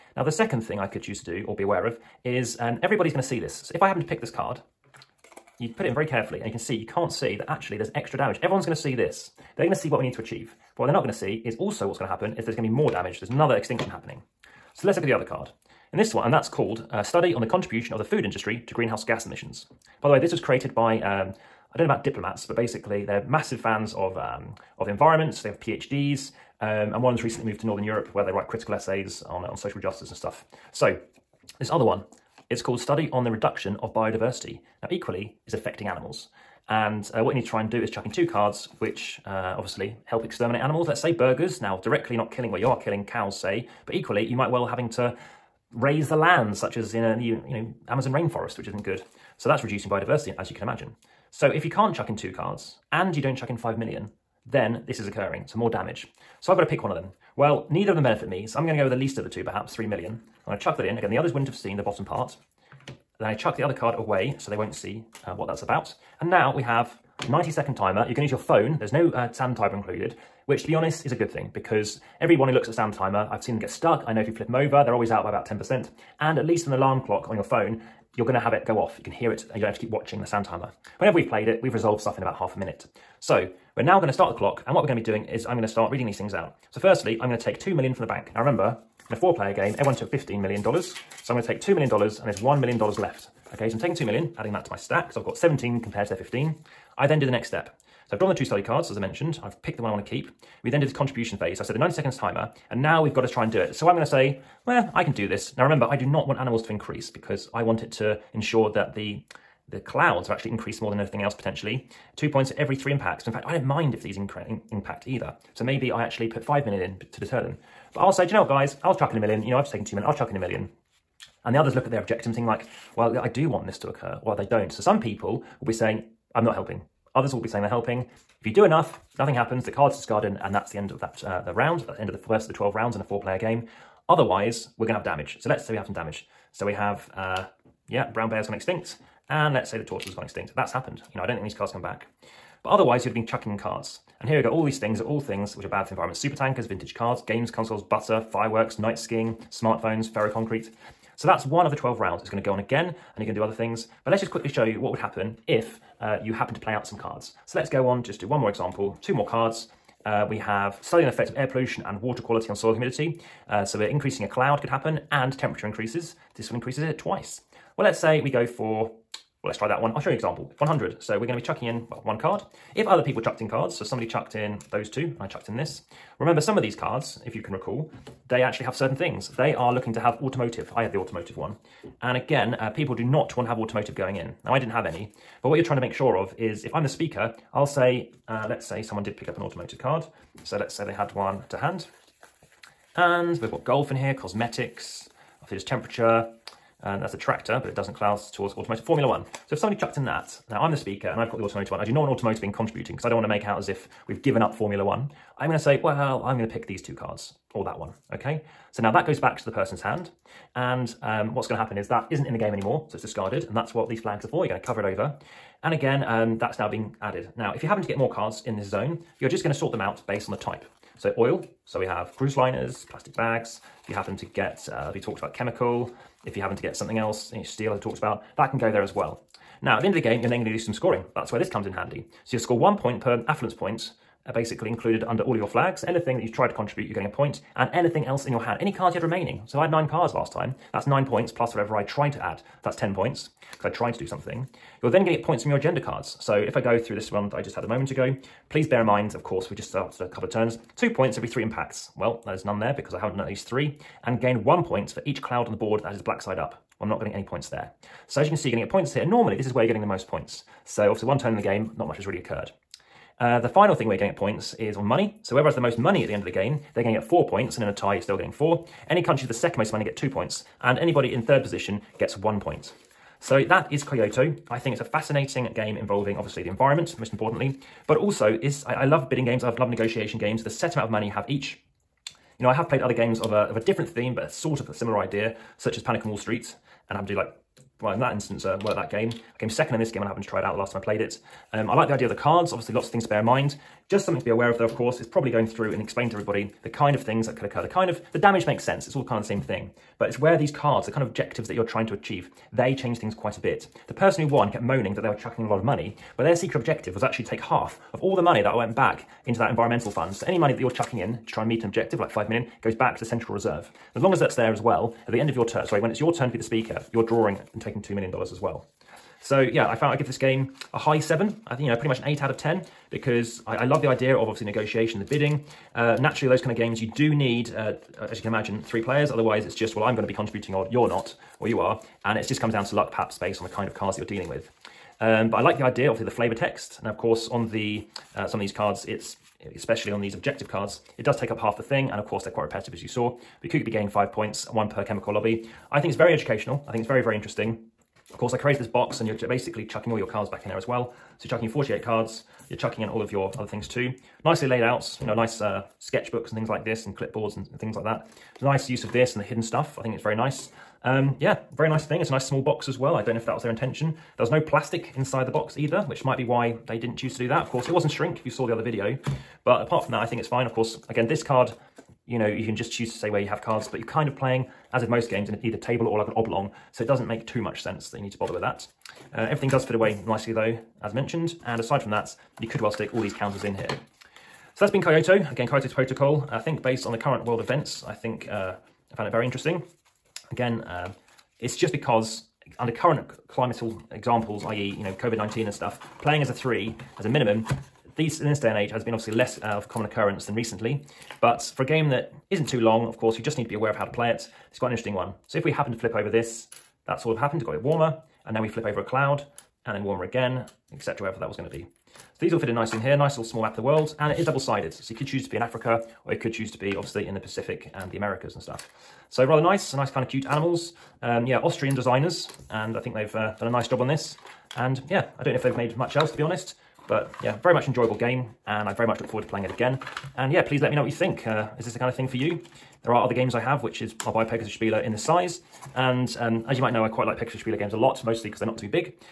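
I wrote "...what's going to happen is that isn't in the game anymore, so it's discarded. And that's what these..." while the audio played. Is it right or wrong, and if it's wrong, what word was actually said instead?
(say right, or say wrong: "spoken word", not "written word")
right.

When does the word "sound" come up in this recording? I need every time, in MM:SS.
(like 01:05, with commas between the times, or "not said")
01:12, 01:20.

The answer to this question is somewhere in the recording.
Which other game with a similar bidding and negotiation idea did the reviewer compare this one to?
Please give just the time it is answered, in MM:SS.
04:45.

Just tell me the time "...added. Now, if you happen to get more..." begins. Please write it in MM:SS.
03:37.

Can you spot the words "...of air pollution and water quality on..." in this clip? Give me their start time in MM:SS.
02:41.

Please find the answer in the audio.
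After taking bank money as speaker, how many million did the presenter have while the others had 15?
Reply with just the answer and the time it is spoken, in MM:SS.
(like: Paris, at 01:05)
17, at 01:35.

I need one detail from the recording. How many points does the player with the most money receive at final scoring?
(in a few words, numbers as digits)
4.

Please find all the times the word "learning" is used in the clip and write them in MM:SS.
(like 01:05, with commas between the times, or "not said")
not said.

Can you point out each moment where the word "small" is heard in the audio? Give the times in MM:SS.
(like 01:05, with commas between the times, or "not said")
06:02, 06:53.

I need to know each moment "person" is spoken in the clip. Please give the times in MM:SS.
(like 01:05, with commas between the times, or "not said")
03:29, 05:03.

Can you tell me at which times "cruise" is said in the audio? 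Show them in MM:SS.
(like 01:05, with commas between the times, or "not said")
03:42.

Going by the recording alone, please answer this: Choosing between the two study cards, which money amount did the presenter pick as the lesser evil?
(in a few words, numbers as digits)
3 million.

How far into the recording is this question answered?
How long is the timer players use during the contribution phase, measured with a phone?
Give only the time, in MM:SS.
01:07.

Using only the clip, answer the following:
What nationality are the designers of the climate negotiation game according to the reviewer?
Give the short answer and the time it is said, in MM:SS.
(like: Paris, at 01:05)
Austrian, at 07:01.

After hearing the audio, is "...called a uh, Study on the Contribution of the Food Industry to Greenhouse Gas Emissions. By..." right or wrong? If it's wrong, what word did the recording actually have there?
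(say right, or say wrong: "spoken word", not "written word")
right.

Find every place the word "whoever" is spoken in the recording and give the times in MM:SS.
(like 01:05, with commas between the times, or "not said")
04:25.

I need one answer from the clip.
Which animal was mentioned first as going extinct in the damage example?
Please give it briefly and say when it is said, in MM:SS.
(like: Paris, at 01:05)
brown bear, at 02:18.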